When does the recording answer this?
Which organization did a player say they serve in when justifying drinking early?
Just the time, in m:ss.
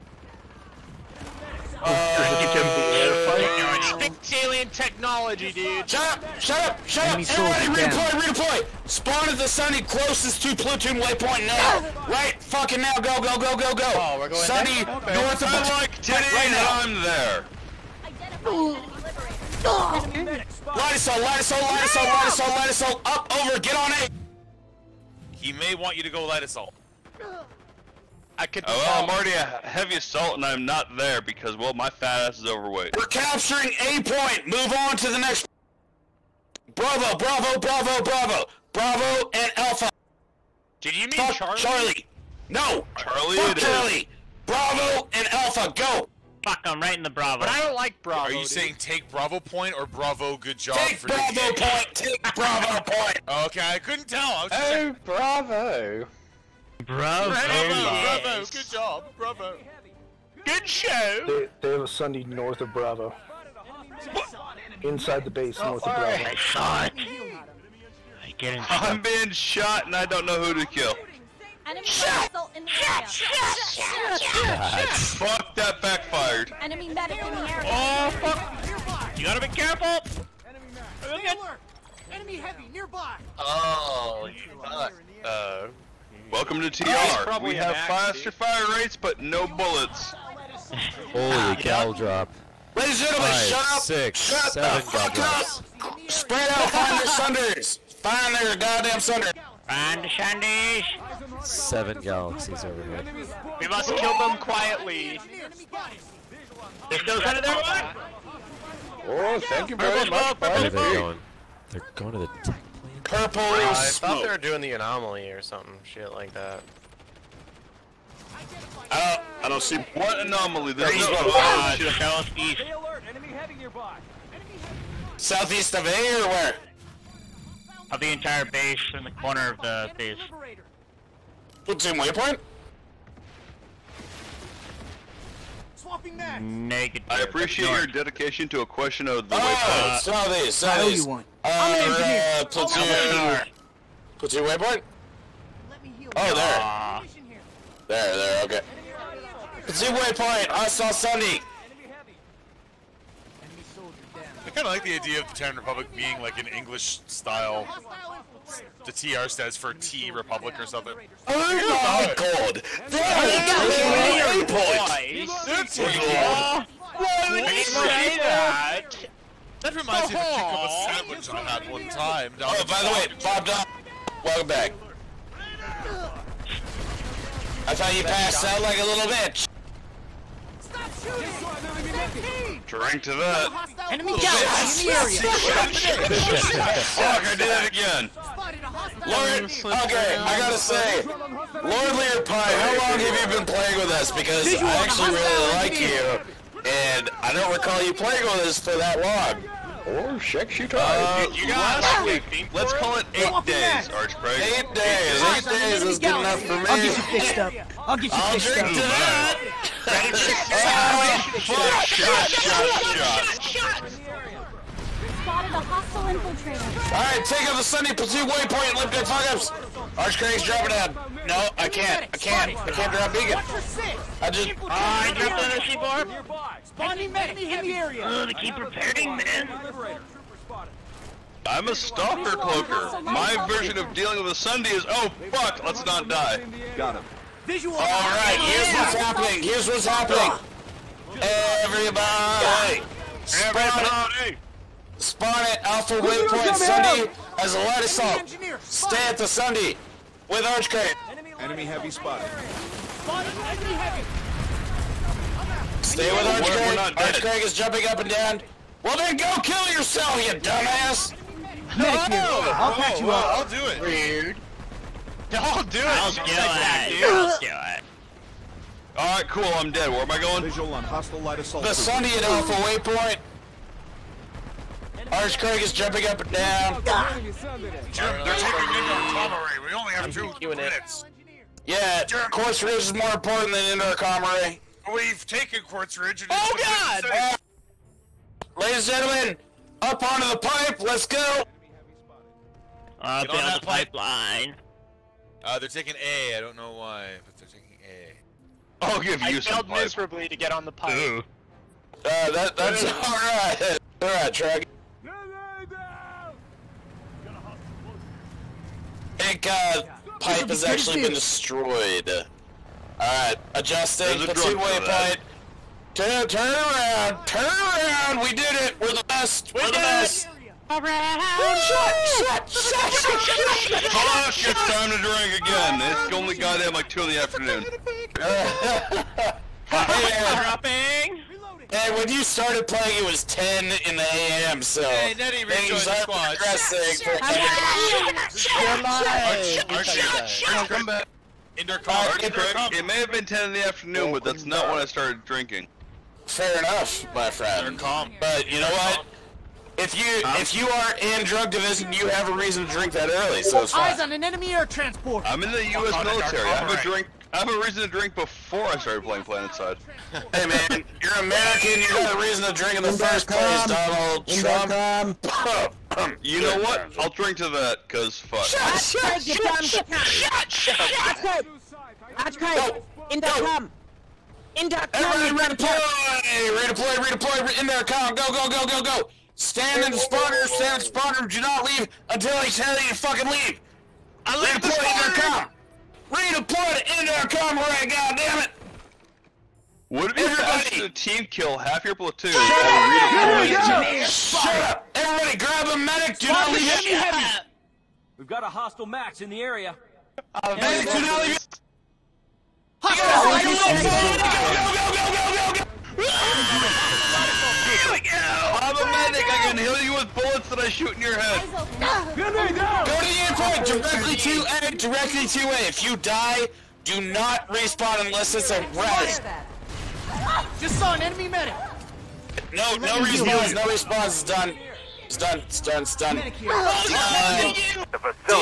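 5:55.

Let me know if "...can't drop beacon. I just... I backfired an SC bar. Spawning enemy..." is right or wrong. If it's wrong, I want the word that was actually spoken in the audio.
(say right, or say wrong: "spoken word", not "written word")
wrong: "dropped", not "backfired".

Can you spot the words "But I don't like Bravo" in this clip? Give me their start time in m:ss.
0:47.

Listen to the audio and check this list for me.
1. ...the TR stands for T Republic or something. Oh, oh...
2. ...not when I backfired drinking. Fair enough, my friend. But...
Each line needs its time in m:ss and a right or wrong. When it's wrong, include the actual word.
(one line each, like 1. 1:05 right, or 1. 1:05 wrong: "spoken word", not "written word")
1. 2:38 right
2. 5:44 wrong: "started", not "backfired".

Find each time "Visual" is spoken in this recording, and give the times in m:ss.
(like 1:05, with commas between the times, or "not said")
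3:57, 4:30.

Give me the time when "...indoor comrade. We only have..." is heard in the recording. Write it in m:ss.
4:38.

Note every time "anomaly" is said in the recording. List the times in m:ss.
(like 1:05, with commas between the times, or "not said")
1:54, 2:00.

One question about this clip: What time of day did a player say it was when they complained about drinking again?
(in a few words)
2 in the afternoon.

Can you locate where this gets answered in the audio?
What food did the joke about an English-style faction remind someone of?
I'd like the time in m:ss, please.
2:50.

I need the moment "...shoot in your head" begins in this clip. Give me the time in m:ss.
6:50.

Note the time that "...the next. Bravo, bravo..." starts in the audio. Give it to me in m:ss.
0:35.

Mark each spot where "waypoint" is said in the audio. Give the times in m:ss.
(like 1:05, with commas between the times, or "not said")
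0:10, 2:11, 2:19, 2:24, 2:29, 3:38, 4:05, 4:32.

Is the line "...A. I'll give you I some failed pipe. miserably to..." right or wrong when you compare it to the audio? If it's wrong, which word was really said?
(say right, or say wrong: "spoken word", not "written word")
right.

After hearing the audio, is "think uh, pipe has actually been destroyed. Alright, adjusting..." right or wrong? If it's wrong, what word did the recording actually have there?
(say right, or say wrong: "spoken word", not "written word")
right.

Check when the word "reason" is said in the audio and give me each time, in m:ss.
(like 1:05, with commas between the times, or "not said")
5:52, 5:57, 6:02.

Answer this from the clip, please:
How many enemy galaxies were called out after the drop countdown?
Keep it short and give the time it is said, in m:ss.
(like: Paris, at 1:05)
7, at 1:41.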